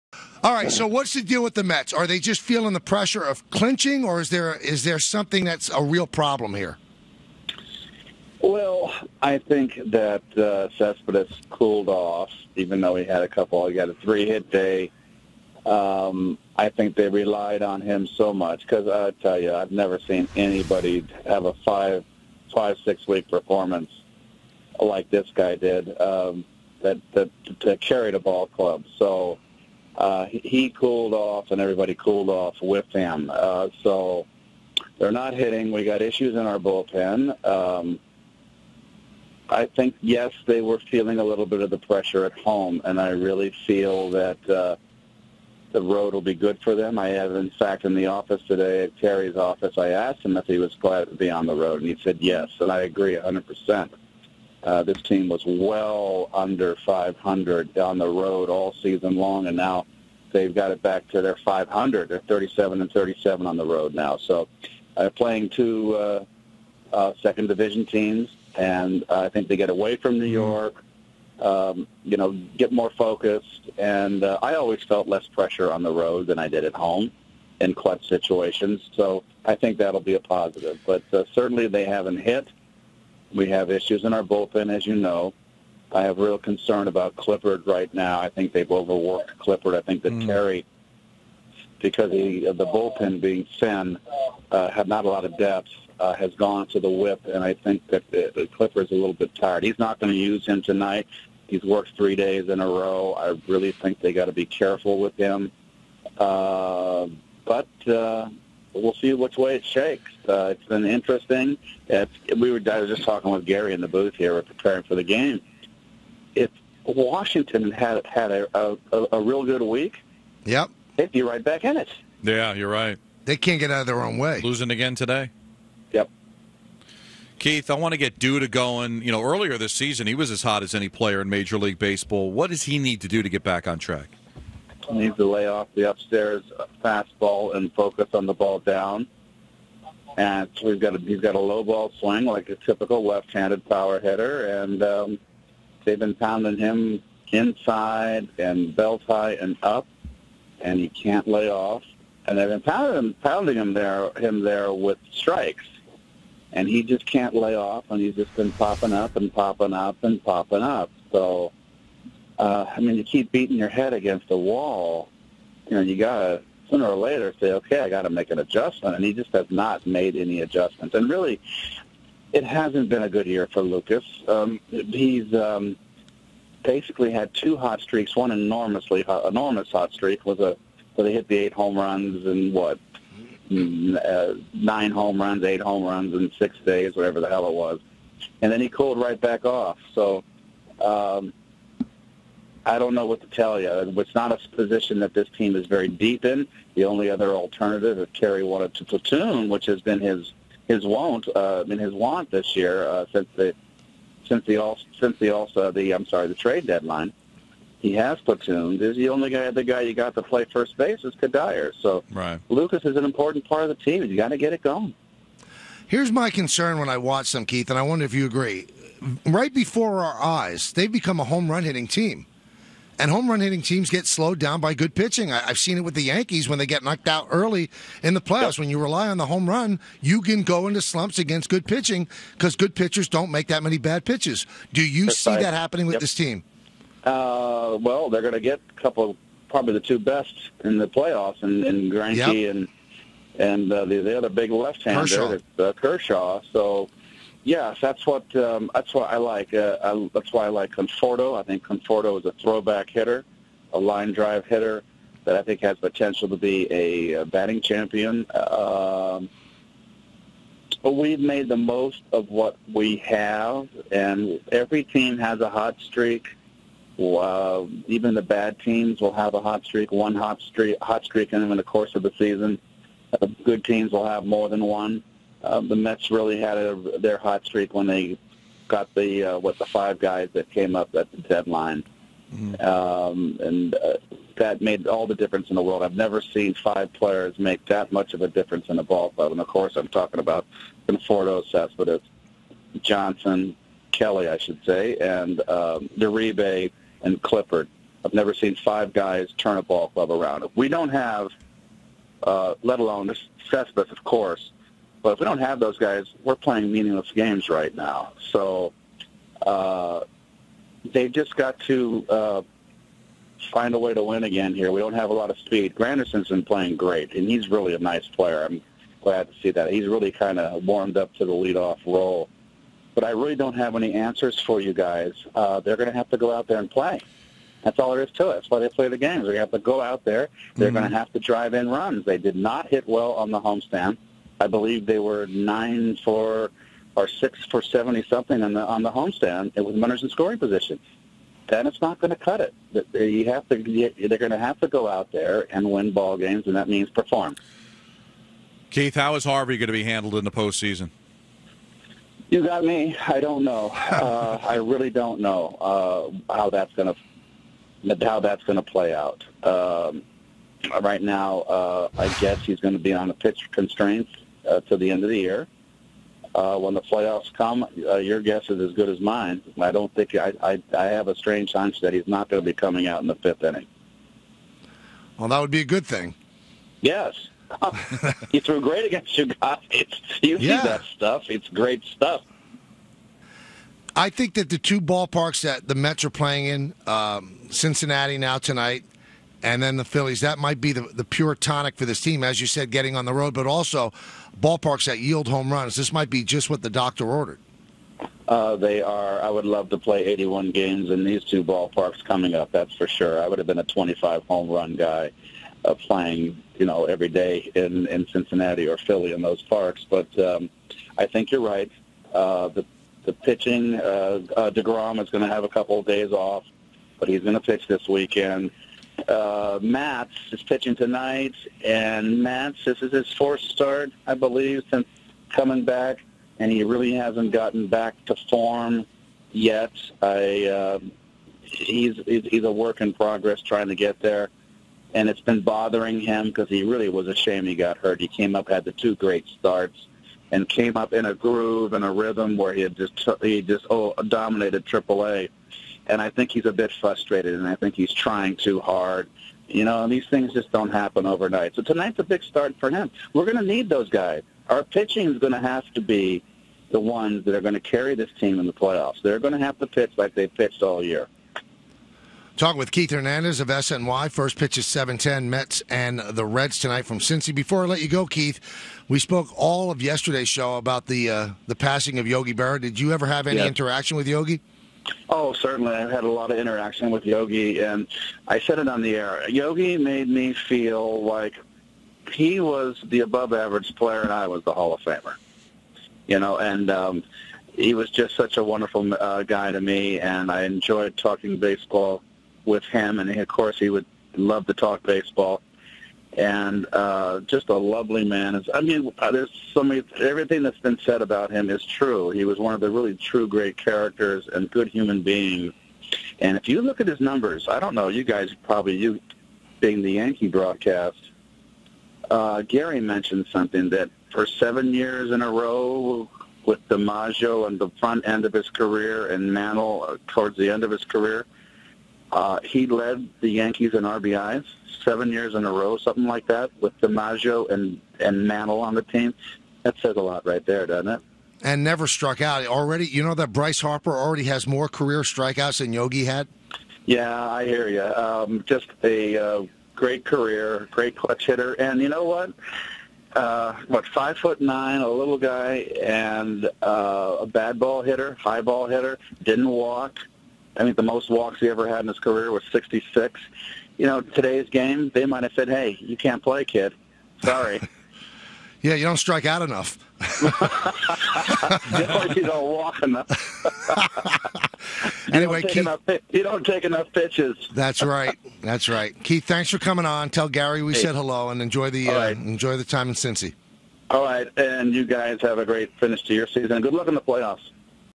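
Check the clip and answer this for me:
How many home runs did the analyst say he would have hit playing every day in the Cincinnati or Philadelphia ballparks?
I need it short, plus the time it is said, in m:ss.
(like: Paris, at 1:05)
25, at 6:43.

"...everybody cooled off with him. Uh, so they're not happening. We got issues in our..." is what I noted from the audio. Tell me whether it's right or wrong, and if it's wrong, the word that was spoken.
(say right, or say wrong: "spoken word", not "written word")
wrong: "hitting", not "happening".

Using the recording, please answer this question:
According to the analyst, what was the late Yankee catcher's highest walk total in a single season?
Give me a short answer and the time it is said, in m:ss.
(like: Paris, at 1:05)
66, at 9:12.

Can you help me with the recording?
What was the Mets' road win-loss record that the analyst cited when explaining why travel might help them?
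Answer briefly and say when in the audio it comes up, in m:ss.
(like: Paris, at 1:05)
37-37, at 1:02.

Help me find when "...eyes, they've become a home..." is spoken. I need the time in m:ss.
3:40.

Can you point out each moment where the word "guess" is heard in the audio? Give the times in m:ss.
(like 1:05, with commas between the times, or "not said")
6:02, 6:08.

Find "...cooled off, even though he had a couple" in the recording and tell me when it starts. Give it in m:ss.
0:11.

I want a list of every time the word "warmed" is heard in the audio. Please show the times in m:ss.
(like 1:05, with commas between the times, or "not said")
5:20.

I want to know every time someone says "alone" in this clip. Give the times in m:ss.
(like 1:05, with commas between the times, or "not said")
5:02.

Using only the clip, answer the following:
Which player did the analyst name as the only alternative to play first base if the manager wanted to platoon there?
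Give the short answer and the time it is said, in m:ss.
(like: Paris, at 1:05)
Cuddyer, at 3:31.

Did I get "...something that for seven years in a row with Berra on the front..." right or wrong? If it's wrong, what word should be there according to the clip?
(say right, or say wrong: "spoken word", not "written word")
wrong: "DiMaggio", not "Berra".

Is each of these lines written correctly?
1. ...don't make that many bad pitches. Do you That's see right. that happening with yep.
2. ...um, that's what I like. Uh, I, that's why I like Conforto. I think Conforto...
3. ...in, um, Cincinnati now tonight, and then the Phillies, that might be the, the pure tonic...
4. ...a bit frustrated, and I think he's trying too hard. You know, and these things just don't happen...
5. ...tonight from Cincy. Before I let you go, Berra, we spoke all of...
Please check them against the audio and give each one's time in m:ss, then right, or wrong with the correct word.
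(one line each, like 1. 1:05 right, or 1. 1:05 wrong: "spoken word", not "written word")
1. 3:53 right
2. 4:08 right
3. 6:26 right
4. 7:26 right
5. 7:46 wrong: "Keith", not "Berra".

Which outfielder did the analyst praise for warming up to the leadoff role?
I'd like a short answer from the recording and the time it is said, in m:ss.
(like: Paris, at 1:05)
Granderson, at 5:15.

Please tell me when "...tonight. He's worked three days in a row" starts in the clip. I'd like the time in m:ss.
1:40.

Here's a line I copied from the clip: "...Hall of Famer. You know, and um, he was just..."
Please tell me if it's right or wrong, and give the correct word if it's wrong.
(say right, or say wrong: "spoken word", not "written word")
right.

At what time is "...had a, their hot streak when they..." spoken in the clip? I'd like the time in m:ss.
4:36.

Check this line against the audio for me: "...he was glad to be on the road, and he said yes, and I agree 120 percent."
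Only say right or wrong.
wrong.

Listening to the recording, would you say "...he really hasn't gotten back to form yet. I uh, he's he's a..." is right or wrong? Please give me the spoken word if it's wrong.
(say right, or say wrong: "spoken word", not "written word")
right.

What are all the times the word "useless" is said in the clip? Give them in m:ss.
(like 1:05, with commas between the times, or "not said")
not said.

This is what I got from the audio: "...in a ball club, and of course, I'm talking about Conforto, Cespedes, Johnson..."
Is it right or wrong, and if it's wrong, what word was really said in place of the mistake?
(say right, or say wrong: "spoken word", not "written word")
right.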